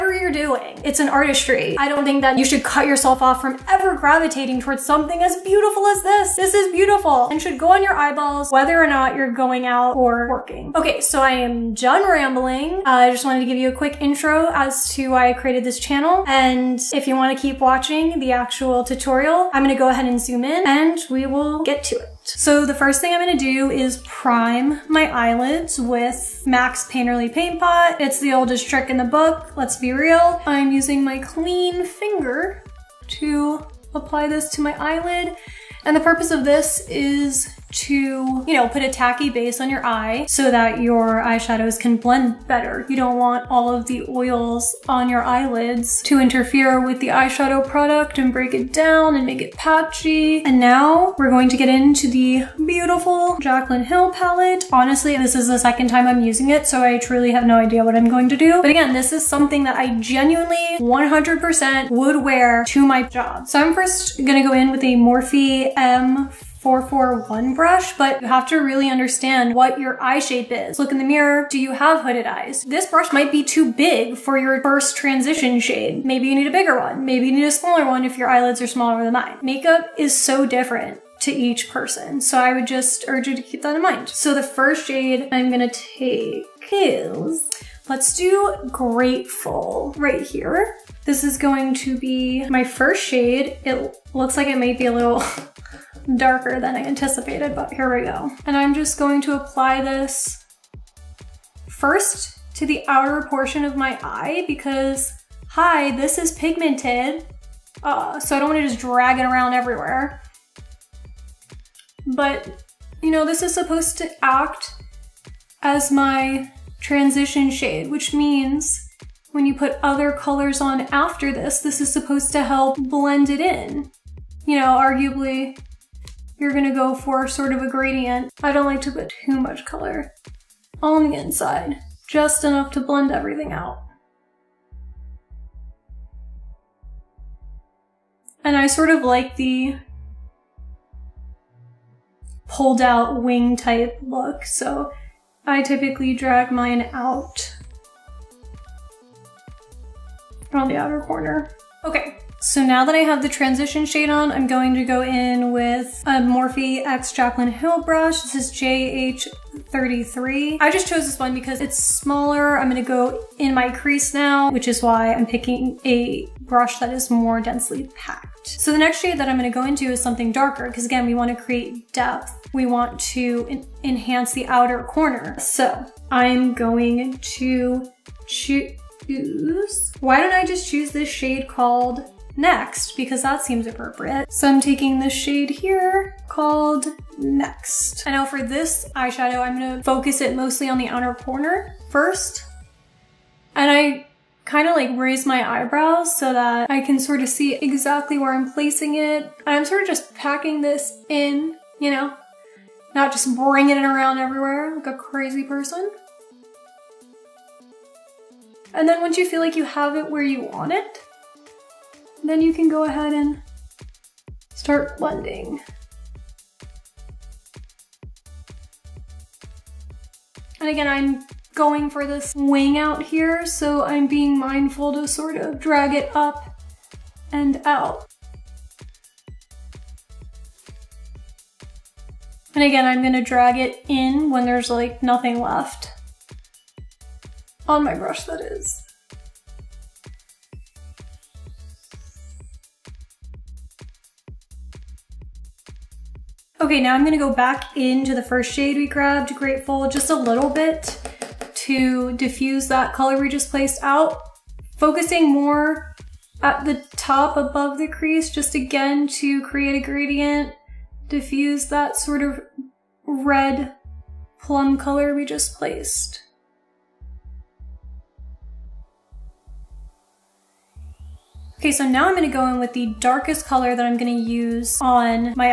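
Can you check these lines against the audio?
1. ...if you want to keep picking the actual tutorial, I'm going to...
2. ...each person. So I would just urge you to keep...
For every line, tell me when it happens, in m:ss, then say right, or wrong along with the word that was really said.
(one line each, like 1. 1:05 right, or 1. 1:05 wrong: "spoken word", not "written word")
1. 0:16 wrong: "watching", not "picking"
2. 1:21 right.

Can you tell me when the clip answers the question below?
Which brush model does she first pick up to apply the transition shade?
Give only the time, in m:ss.
1:04.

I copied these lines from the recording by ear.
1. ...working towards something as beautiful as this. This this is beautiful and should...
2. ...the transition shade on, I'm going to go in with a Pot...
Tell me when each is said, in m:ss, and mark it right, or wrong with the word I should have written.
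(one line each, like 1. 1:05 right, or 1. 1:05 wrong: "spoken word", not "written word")
1. 0:03 wrong: "gravitating", not "working"
2. 2:33 wrong: "Morphe", not "Pot".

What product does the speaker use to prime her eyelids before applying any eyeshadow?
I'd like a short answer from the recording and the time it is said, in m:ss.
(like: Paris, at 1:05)
Mac's Painterly Paint Pot, at 0:26.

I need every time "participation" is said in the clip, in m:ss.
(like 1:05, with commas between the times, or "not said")
not said.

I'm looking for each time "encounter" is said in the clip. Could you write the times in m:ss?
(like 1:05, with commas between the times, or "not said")
not said.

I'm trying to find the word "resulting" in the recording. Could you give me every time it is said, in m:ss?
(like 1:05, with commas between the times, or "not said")
not said.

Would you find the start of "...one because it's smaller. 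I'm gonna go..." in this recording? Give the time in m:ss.
2:41.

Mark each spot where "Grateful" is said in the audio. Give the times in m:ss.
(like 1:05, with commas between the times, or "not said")
1:28, 4:09.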